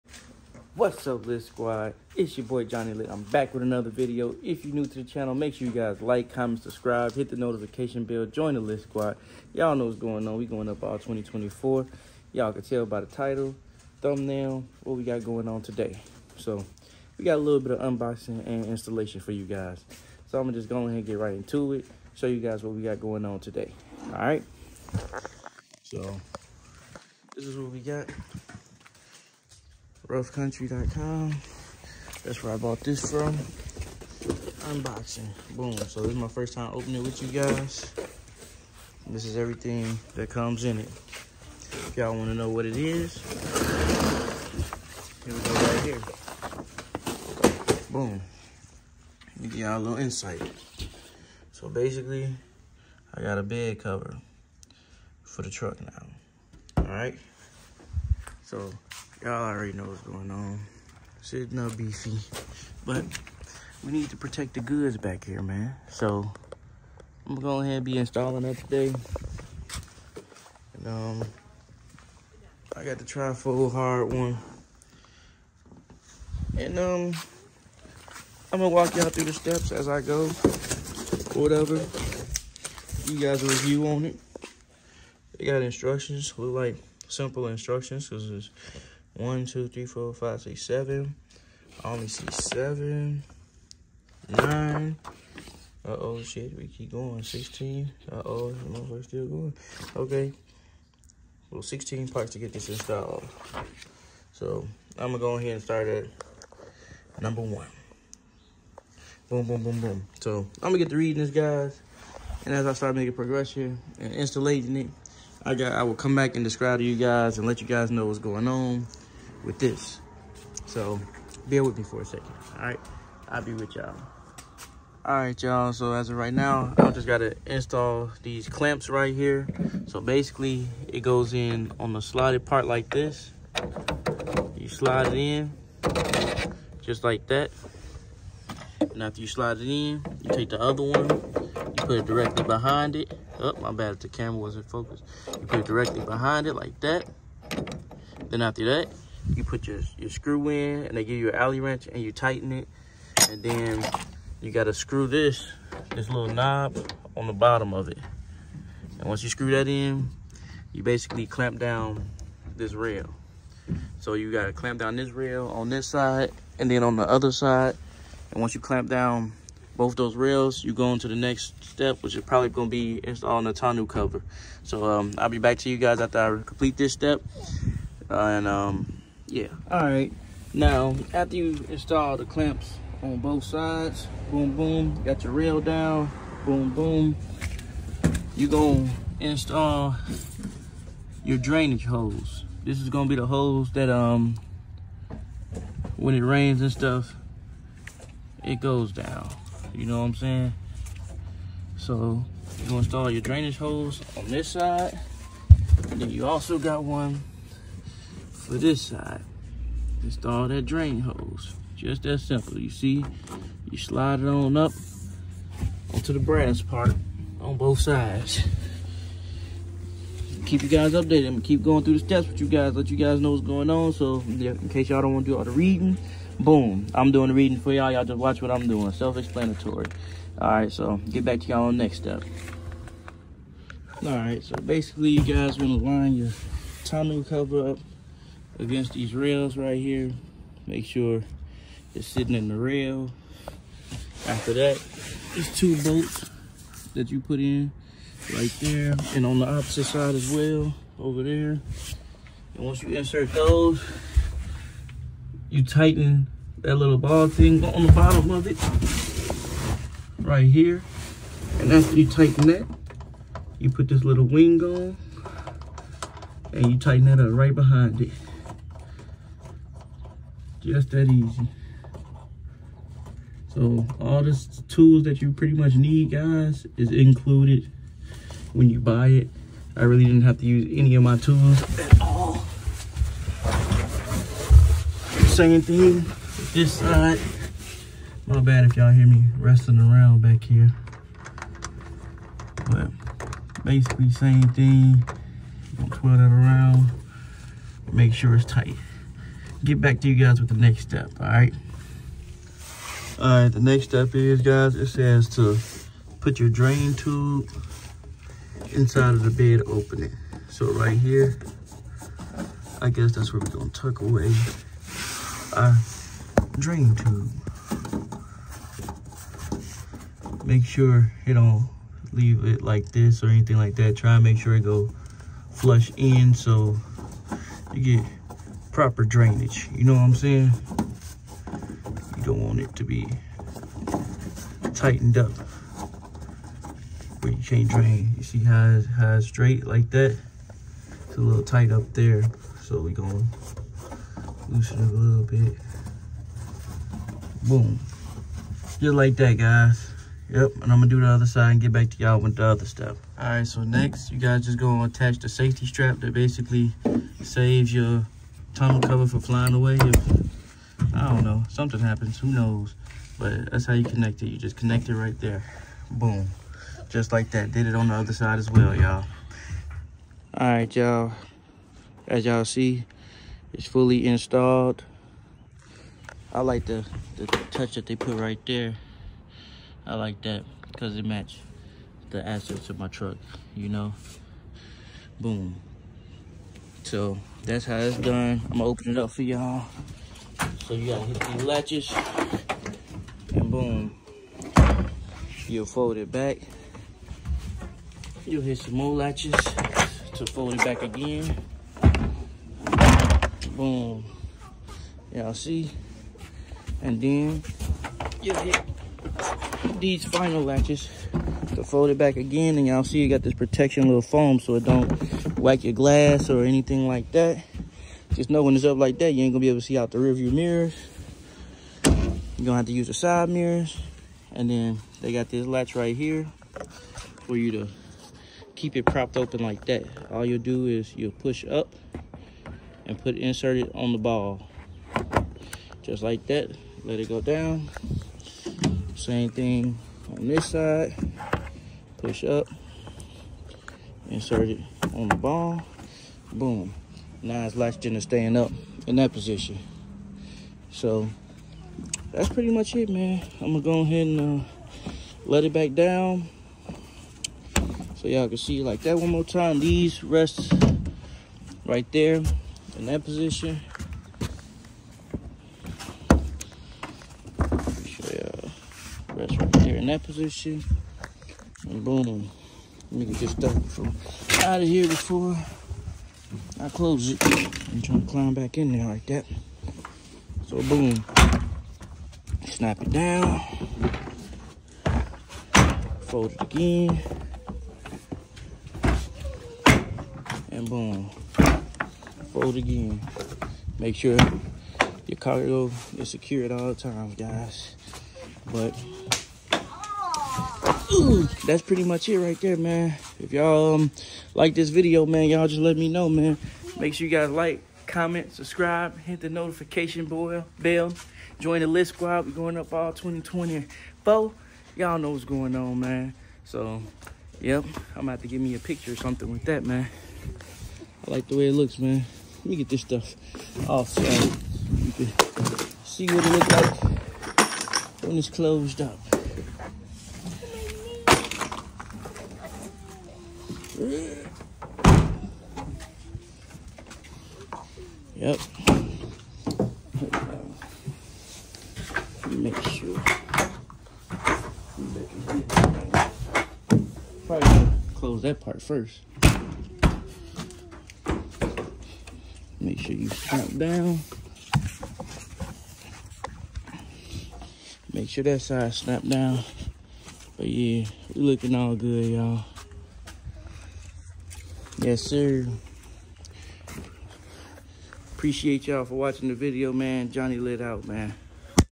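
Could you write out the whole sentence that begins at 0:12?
Y'all can tell by the title, thumbnail, what we got going on today.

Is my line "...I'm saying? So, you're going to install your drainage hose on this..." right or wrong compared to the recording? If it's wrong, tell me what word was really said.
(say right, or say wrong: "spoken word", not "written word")
right.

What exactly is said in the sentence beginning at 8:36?
So, yep, I'm about to give me a picture or something with that, man.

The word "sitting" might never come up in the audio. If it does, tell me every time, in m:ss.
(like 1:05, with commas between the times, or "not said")
1:01, 4:02.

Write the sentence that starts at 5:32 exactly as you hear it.
You don't want it to be tightened up where you can't drain.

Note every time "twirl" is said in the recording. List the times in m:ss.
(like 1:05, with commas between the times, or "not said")
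4:55.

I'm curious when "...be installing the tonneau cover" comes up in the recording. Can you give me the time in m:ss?
2:52.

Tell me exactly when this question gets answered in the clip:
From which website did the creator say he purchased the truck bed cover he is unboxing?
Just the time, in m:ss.
0:30.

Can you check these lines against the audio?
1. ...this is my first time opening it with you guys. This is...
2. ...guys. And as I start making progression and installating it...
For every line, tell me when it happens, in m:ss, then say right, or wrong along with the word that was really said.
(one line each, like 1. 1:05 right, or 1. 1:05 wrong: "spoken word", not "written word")
1. 0:36 right
2. 1:51 right.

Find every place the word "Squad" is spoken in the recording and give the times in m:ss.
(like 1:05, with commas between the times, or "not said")
0:01, 0:08, 8:31.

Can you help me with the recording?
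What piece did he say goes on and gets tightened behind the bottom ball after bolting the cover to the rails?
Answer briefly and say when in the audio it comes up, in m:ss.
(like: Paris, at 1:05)
wing, at 4:24.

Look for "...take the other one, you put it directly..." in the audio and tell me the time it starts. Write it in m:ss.
2:20.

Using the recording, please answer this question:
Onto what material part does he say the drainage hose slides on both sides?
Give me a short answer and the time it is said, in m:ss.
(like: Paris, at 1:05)
brass, at 3:36.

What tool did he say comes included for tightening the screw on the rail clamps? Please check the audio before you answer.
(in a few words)
alley wrench.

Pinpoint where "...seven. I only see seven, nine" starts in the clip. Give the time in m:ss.
1:30.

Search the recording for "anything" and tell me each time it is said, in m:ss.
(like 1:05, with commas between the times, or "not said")
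5:23, 6:56.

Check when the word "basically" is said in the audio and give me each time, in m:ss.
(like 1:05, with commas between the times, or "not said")
0:51, 2:10, 2:40, 3:54, 4:53, 5:56.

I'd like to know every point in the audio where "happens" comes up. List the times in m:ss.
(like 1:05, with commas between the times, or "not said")
6:01.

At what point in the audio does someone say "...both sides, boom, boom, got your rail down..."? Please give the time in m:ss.
3:03.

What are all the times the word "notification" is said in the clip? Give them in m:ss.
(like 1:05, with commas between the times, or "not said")
0:07, 8:29.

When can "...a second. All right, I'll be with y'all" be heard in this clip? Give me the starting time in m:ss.
2:02.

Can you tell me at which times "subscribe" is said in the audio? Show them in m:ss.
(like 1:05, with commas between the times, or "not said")
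0:06, 8:28.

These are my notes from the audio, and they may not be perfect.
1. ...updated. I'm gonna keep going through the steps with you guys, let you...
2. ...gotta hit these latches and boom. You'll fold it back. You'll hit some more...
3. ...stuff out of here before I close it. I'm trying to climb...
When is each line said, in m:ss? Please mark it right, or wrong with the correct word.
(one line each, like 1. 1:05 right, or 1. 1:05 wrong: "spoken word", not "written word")
1. 3:40 right
2. 6:30 right
3. 7:53 right.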